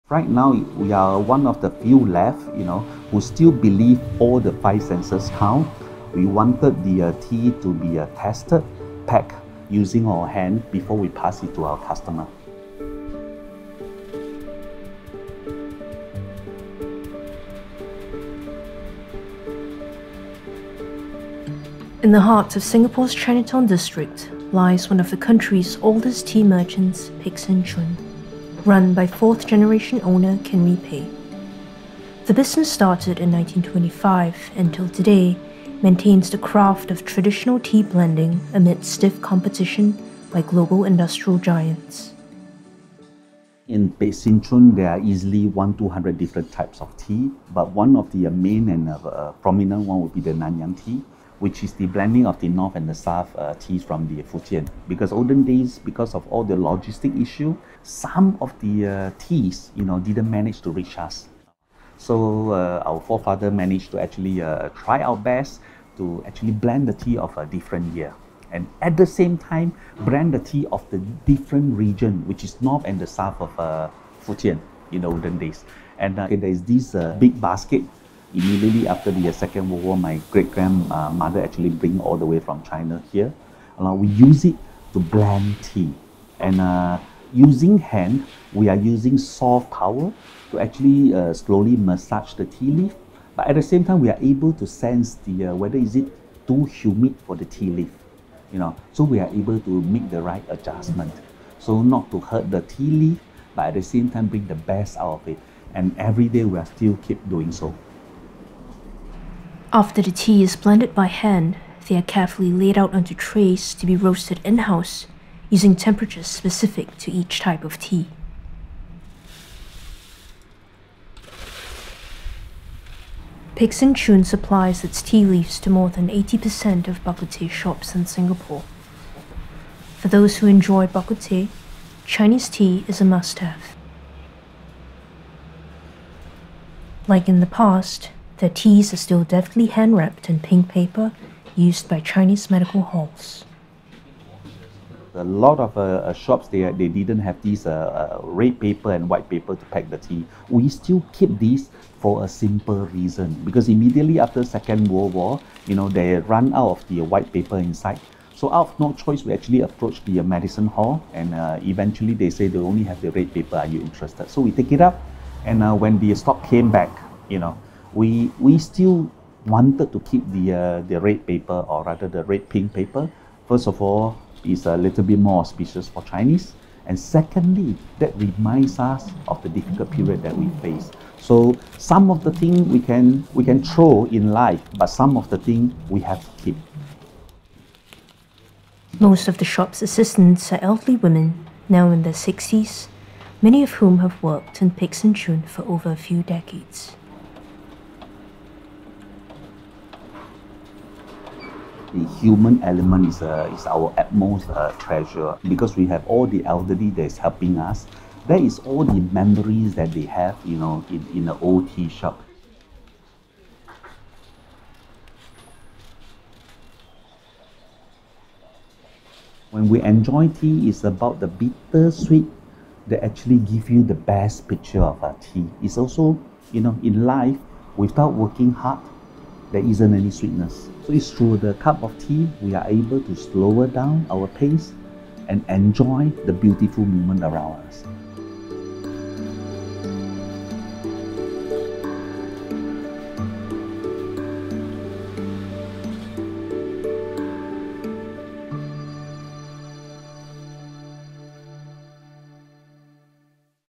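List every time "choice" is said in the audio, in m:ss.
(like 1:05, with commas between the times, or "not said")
2:38.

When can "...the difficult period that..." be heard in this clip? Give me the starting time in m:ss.
2:59.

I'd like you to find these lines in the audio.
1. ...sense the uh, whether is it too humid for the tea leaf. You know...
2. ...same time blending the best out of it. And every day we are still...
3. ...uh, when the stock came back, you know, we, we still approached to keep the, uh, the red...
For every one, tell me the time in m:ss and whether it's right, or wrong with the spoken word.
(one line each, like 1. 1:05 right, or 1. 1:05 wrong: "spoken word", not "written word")
1. 1:34 right
2. 1:43 wrong: "bring", not "blending"
3. 2:45 wrong: "wanted", not "approached".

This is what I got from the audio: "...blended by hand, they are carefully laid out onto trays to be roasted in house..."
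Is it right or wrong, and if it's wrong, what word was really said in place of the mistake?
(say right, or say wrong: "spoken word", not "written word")
right.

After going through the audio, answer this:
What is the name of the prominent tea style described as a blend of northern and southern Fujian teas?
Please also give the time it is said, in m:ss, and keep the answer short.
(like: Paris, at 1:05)
Nanyang tea, at 0:50.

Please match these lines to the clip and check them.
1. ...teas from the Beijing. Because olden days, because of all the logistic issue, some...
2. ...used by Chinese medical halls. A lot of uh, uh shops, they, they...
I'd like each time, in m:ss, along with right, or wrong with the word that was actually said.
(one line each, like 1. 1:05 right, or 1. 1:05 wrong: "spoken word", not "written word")
1. 0:53 wrong: "Fujian", not "Beijing"
2. 2:21 right.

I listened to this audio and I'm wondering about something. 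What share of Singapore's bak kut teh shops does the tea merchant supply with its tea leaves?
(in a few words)
More than 80%.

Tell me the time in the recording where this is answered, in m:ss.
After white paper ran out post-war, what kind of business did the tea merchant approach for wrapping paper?
2:40.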